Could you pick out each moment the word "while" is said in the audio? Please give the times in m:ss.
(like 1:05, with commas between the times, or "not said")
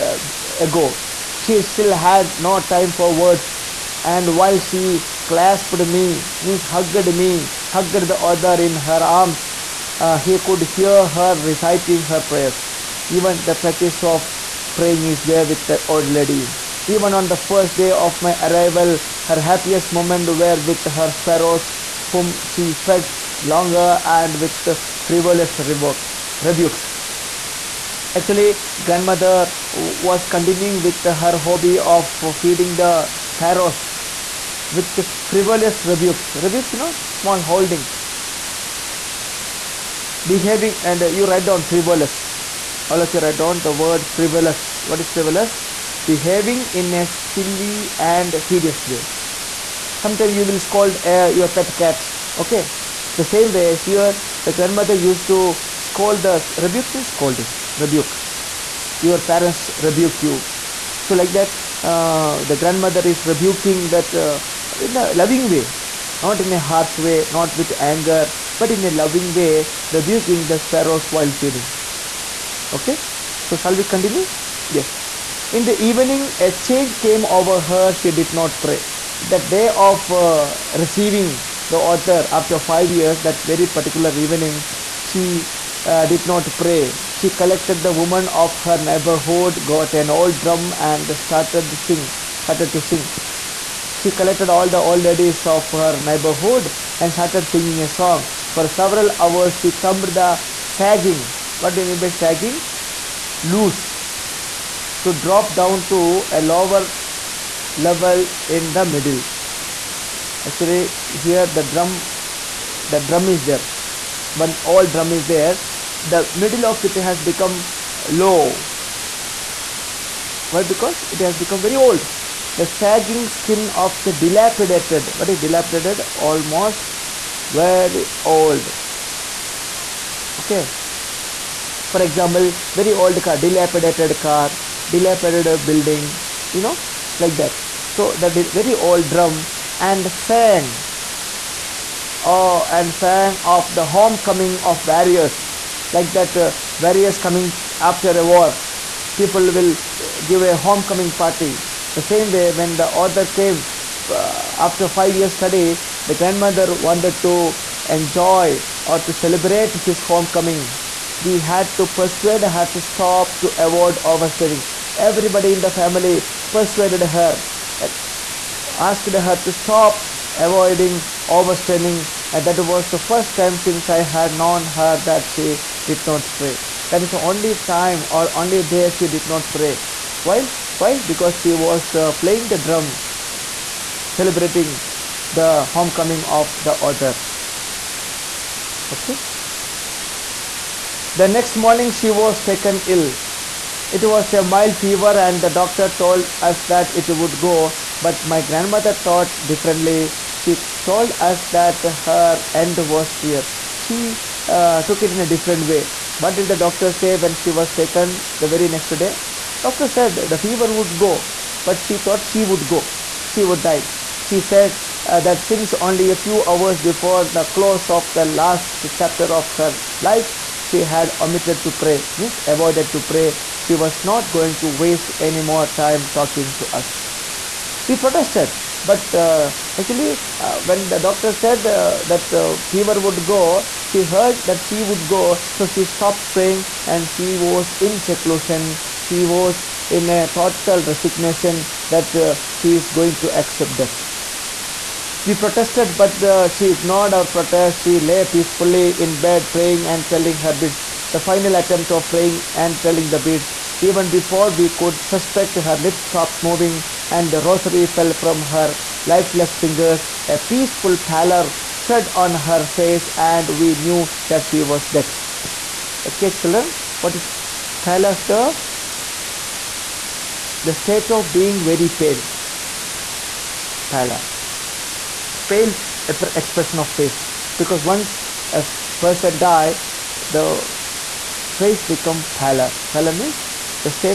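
0:04, 1:11.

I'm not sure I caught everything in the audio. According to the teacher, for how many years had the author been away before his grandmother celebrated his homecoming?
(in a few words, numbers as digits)
5.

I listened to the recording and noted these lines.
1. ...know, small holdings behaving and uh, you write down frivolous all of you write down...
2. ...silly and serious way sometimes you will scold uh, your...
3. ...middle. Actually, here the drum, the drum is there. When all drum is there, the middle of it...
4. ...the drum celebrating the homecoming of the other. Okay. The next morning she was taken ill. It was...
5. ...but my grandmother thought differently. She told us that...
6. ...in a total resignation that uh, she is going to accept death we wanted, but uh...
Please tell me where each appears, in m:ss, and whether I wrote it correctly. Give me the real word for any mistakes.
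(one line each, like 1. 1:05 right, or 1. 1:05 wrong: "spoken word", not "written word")
1. 0:36 right
2. 0:47 right
3. 1:48 right
4. 3:02 right
5. 3:17 right
6. 3:59 wrong: "protested", not "wanted".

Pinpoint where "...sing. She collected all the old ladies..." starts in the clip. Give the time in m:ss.
1:32.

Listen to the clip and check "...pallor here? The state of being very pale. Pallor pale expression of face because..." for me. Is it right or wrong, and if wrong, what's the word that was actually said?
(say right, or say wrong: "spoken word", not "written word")
right.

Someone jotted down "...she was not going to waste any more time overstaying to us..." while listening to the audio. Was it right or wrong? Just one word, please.
wrong.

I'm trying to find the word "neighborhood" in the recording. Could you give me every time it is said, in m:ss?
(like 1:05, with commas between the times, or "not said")
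1:28, 1:36.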